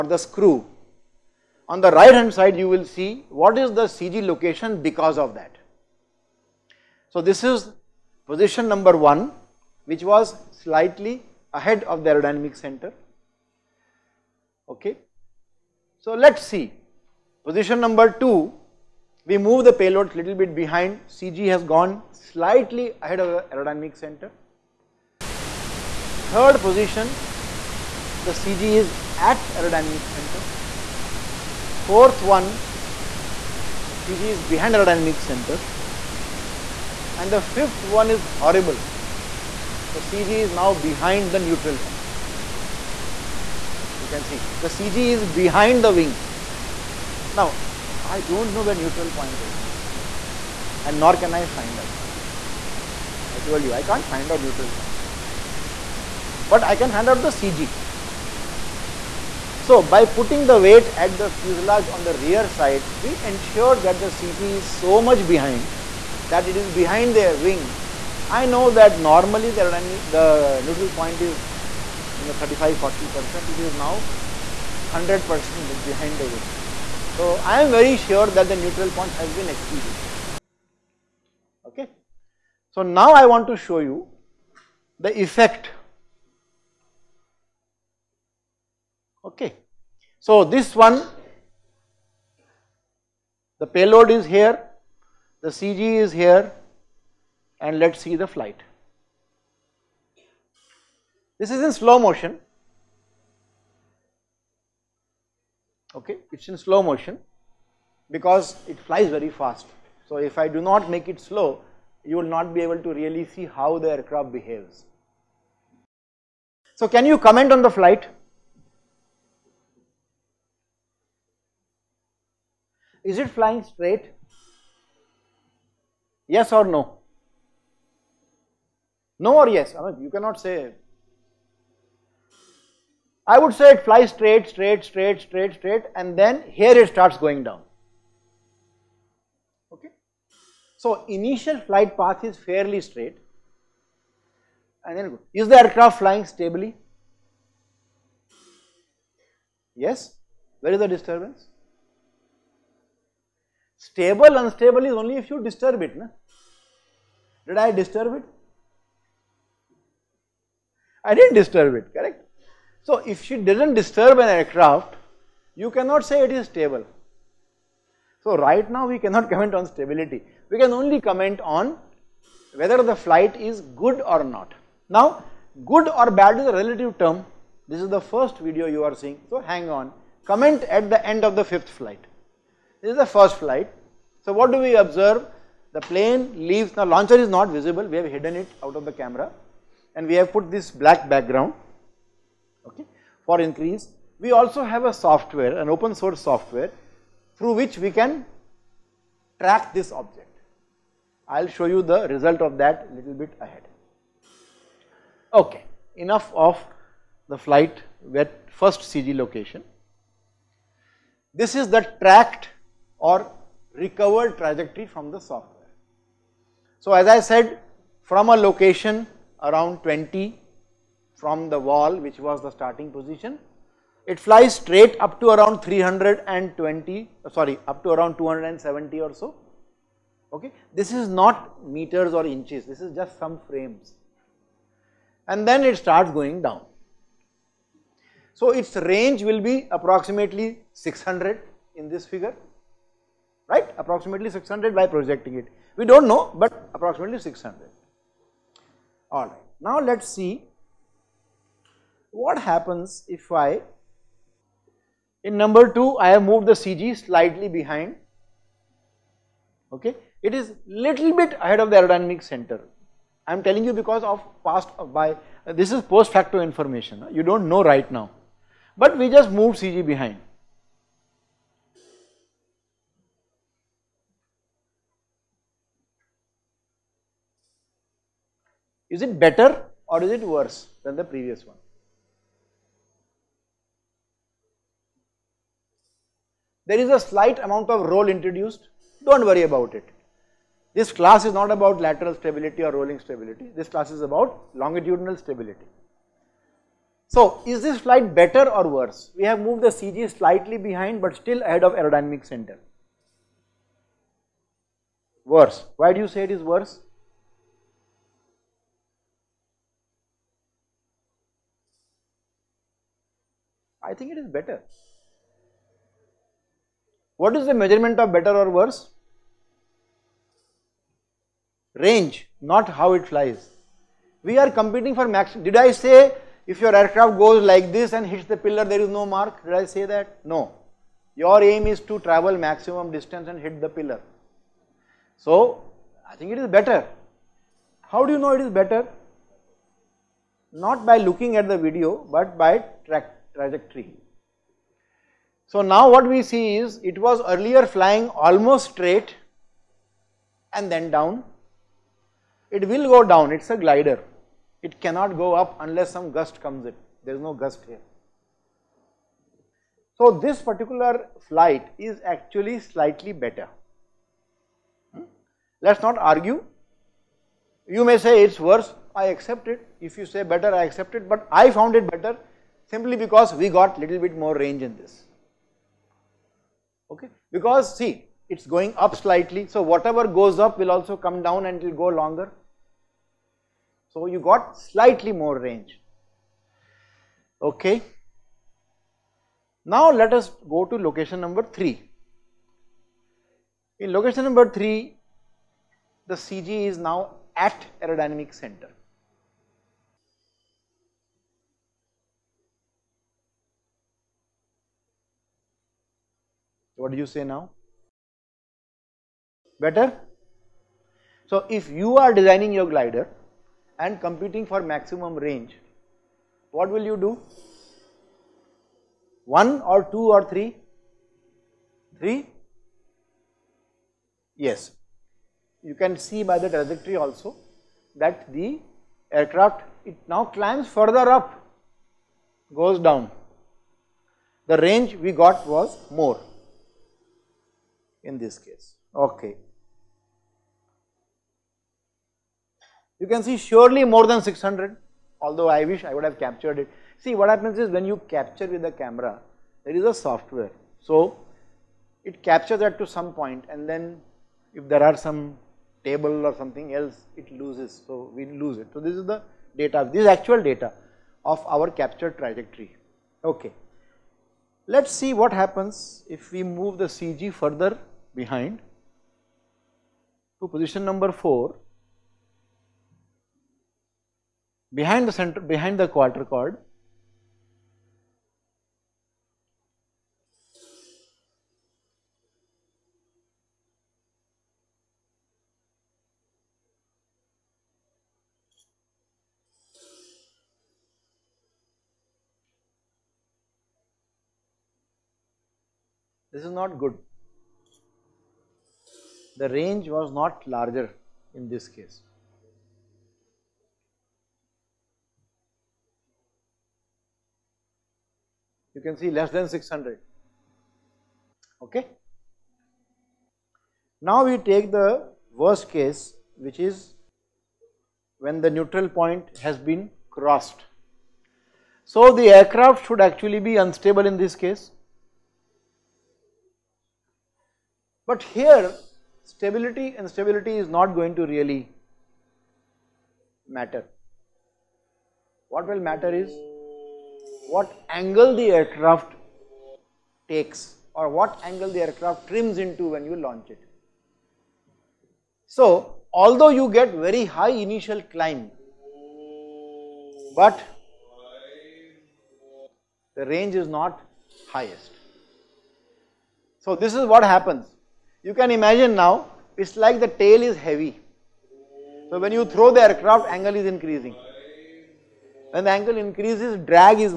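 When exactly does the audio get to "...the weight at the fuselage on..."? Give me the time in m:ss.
1:00.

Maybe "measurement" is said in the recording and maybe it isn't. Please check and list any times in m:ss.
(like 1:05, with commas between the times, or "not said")
5:17.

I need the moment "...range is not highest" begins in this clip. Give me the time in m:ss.
9:13.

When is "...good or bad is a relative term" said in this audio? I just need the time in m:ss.
2:55.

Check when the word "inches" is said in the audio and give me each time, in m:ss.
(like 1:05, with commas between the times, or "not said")
3:52.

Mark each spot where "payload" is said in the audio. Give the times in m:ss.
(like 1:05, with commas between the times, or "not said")
0:19, 1:33.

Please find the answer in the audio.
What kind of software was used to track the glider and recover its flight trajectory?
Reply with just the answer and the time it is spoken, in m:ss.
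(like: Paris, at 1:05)
Open source software, at 3:15.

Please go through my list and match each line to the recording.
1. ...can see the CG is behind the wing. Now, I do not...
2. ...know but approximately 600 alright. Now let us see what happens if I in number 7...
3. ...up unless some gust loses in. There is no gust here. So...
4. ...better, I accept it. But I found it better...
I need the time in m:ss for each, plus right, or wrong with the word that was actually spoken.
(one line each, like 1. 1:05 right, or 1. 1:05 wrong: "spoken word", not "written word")
1. 0:44 right
2. 4:06 wrong: "2", not "7"
3. 5:55 wrong: "comes", not "loses"
4. 6:10 right.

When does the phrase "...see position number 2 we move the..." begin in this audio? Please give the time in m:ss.
0:16.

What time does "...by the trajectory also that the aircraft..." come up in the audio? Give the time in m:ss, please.
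7:06.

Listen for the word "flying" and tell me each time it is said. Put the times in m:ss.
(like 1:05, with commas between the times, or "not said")
2:03, 2:25, 5:47.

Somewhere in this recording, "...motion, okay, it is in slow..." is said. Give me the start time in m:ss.
1:41.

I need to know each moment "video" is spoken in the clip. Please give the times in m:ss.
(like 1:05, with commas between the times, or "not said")
2:58, 5:41.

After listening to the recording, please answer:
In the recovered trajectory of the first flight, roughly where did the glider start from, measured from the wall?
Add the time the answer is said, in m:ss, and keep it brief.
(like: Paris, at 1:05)
Around 20, at 3:39.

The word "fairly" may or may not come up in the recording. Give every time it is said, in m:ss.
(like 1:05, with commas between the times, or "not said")
2:22.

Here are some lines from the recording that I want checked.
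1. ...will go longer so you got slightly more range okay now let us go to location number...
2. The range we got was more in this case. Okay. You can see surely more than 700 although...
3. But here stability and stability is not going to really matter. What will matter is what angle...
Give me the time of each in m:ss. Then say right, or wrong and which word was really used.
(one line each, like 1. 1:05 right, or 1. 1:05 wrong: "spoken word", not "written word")
1. 6:21 right
2. 7:14 wrong: "600", not "700"
3. 8:48 right.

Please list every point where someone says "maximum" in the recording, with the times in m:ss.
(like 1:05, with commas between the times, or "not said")
5:32, 6:54.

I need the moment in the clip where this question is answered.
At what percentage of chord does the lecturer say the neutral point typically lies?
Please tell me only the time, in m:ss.
1:12.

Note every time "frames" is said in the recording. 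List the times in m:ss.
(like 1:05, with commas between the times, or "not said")
3:53.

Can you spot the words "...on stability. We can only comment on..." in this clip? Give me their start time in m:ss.
2:49.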